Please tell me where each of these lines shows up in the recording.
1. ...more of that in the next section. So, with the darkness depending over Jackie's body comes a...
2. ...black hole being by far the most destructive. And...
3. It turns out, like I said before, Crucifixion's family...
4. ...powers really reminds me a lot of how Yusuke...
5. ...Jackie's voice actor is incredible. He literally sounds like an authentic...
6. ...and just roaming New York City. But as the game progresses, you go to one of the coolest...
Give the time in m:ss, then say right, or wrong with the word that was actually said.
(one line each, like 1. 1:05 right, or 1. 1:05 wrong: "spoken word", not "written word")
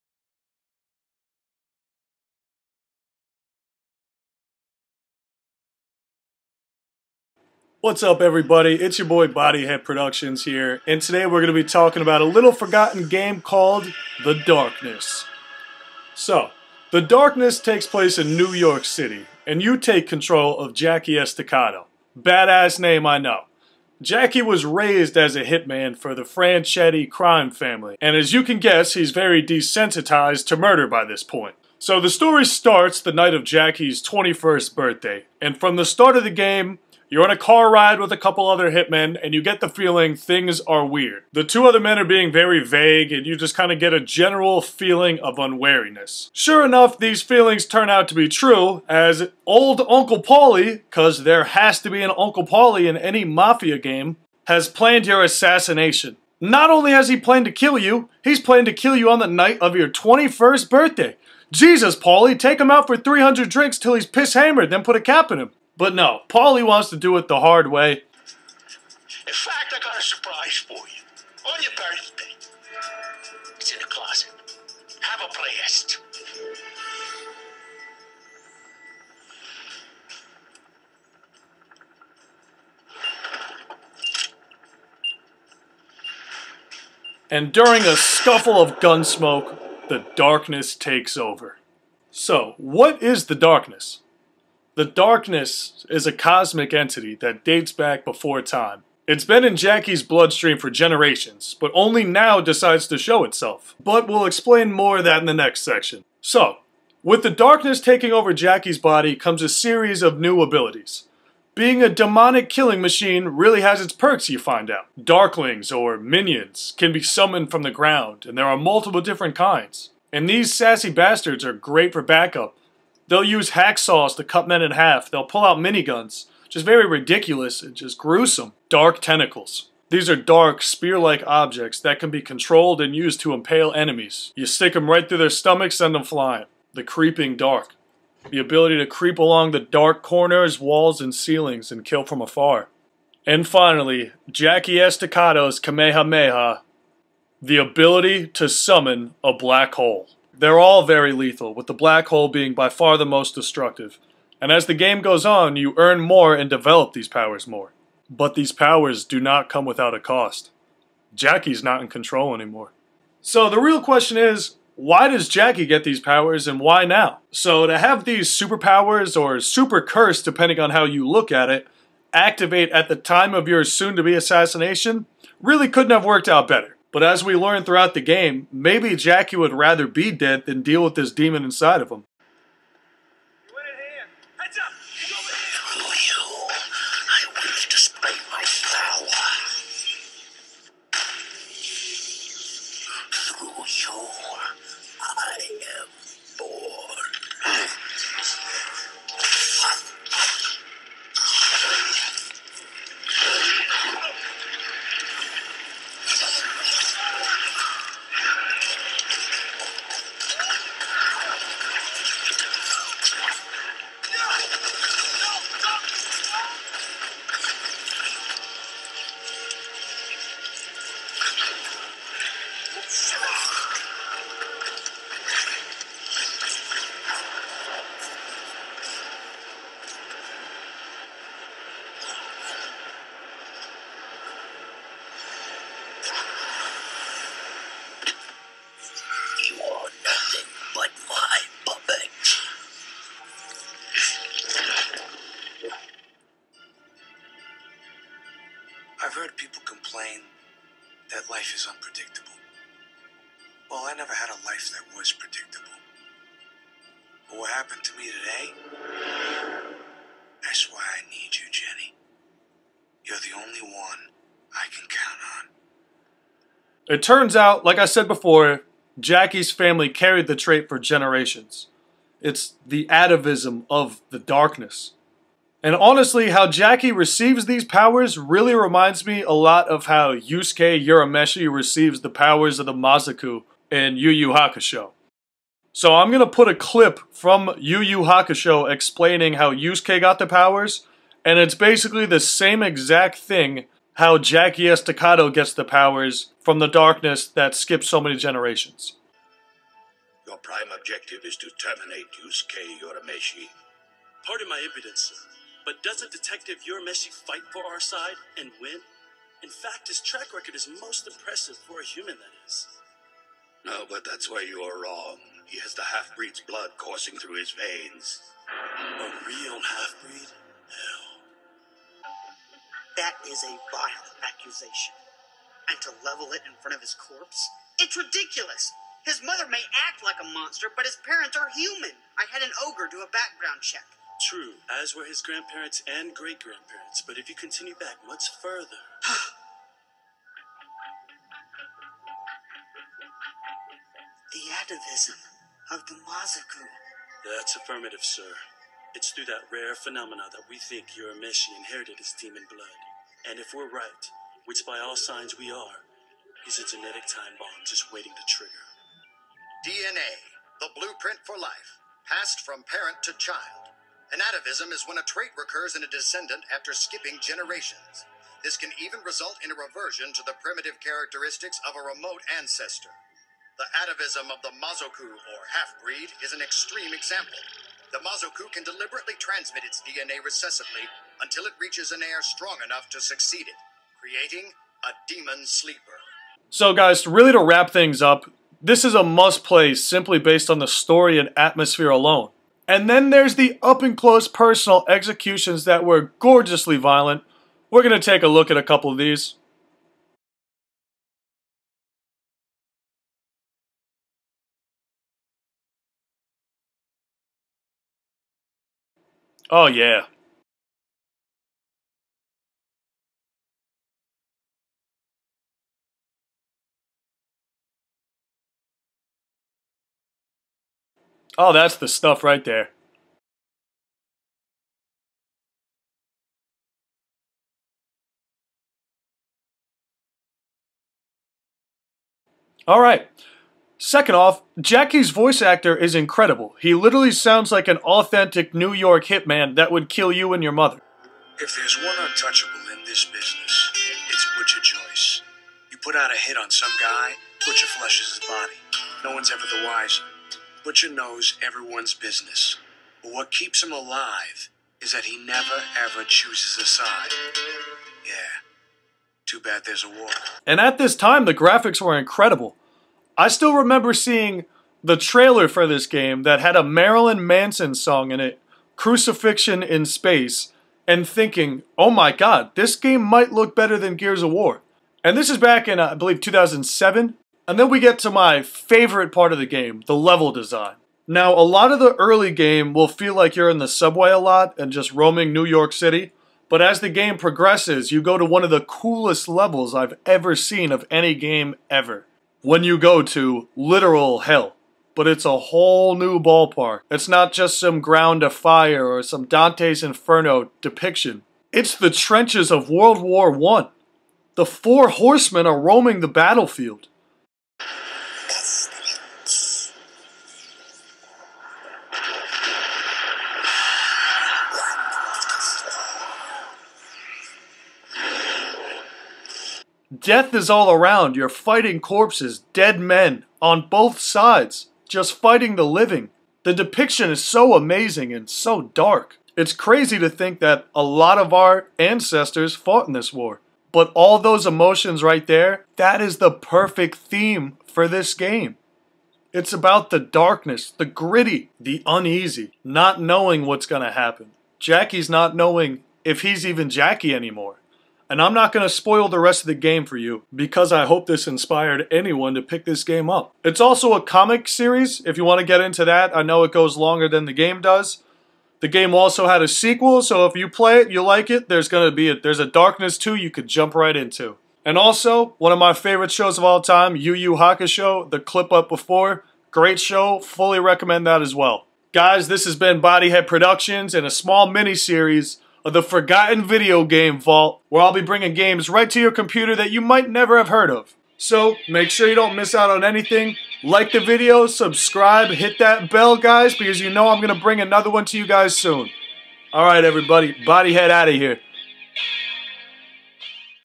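1. 1:44 wrong: "taking", not "depending"
2. 2:31 right
3. 4:26 wrong: "Jackie", not "Crucifixion"
4. 4:37 right
5. 7:14 right
6. 8:04 right.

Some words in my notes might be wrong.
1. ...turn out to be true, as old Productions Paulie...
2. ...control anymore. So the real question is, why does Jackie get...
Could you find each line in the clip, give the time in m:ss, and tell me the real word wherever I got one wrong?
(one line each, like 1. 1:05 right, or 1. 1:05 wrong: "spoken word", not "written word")
1. 0:47 wrong: "Uncle", not "Productions"
2. 2:41 right.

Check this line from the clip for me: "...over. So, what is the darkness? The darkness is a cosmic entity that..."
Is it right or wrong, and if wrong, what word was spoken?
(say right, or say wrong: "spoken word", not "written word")
right.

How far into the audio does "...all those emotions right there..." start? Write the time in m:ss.
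8:53.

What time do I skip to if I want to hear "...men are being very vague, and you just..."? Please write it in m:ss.
0:41.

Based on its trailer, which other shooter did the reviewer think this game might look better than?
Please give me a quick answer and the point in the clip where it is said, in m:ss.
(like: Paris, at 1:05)
Gears of War, at 7:53.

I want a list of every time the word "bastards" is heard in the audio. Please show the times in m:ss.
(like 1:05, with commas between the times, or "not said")
2:00.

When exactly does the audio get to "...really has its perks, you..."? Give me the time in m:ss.
1:53.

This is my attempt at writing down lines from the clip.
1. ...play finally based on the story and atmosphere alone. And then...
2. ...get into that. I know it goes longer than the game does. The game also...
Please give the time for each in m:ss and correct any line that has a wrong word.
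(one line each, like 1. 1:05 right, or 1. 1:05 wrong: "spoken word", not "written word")
1. 6:29 wrong: "simply", not "finally"
2. 9:15 right.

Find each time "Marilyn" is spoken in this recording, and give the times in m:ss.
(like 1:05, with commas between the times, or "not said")
7:46.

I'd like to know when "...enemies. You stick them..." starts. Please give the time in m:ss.
2:13.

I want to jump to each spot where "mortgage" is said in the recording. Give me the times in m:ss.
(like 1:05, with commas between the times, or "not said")
not said.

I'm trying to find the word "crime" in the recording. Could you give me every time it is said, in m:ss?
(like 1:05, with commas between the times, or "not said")
0:27.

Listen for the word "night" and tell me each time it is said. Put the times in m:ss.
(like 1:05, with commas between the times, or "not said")
0:33, 0:59.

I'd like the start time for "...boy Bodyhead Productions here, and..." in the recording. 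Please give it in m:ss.
0:09.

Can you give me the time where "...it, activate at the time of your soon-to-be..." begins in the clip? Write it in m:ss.
2:51.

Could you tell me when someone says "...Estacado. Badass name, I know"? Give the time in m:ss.
0:21.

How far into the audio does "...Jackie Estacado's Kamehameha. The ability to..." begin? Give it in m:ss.
2:24.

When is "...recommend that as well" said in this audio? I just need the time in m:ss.
9:30.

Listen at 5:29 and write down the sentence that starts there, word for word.
His mother may act like a monster, but his parents are human.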